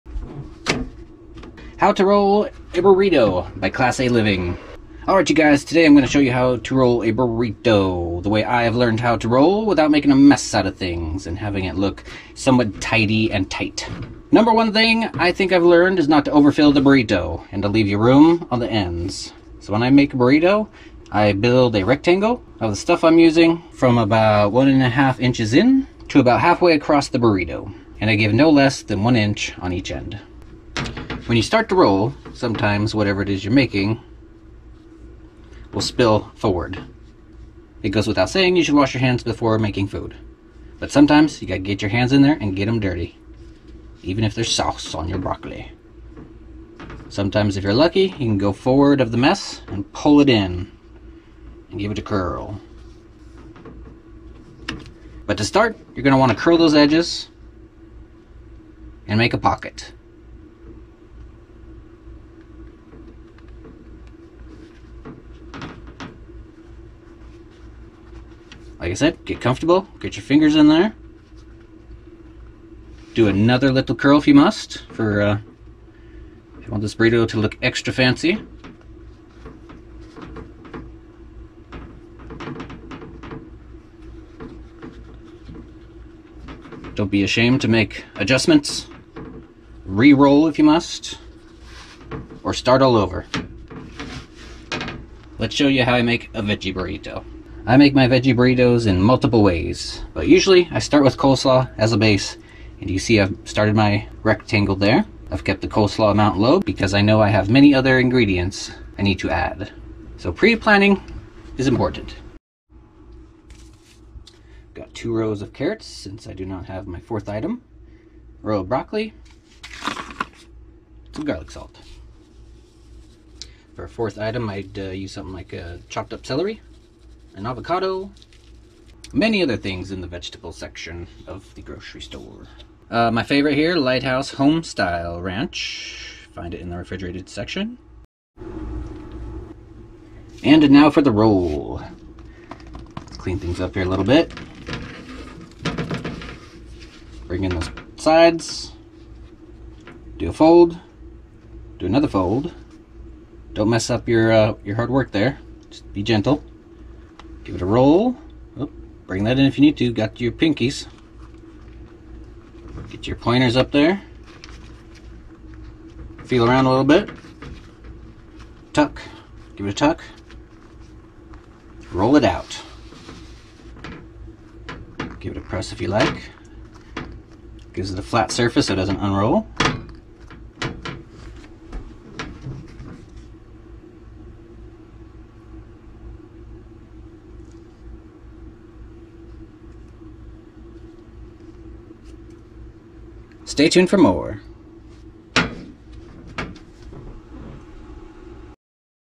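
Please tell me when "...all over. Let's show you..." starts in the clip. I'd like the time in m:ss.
1:32.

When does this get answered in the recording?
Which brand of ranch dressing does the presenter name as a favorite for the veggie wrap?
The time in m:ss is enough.
2:13.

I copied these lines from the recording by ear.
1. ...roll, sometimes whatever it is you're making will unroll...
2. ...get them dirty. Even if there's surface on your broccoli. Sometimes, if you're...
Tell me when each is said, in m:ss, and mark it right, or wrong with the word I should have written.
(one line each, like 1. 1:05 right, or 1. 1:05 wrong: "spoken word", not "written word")
1. 0:31 wrong: "spill", not "unroll"
2. 0:42 wrong: "sauce", not "surface".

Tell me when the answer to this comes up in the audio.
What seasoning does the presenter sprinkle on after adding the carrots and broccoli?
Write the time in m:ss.
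2:01.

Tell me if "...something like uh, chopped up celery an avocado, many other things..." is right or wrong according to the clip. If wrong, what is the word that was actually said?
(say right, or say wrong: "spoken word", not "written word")
right.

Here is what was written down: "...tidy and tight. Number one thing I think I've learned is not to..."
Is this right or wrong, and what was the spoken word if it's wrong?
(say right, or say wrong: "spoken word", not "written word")
right.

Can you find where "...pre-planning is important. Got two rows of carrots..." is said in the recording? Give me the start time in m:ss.
1:50.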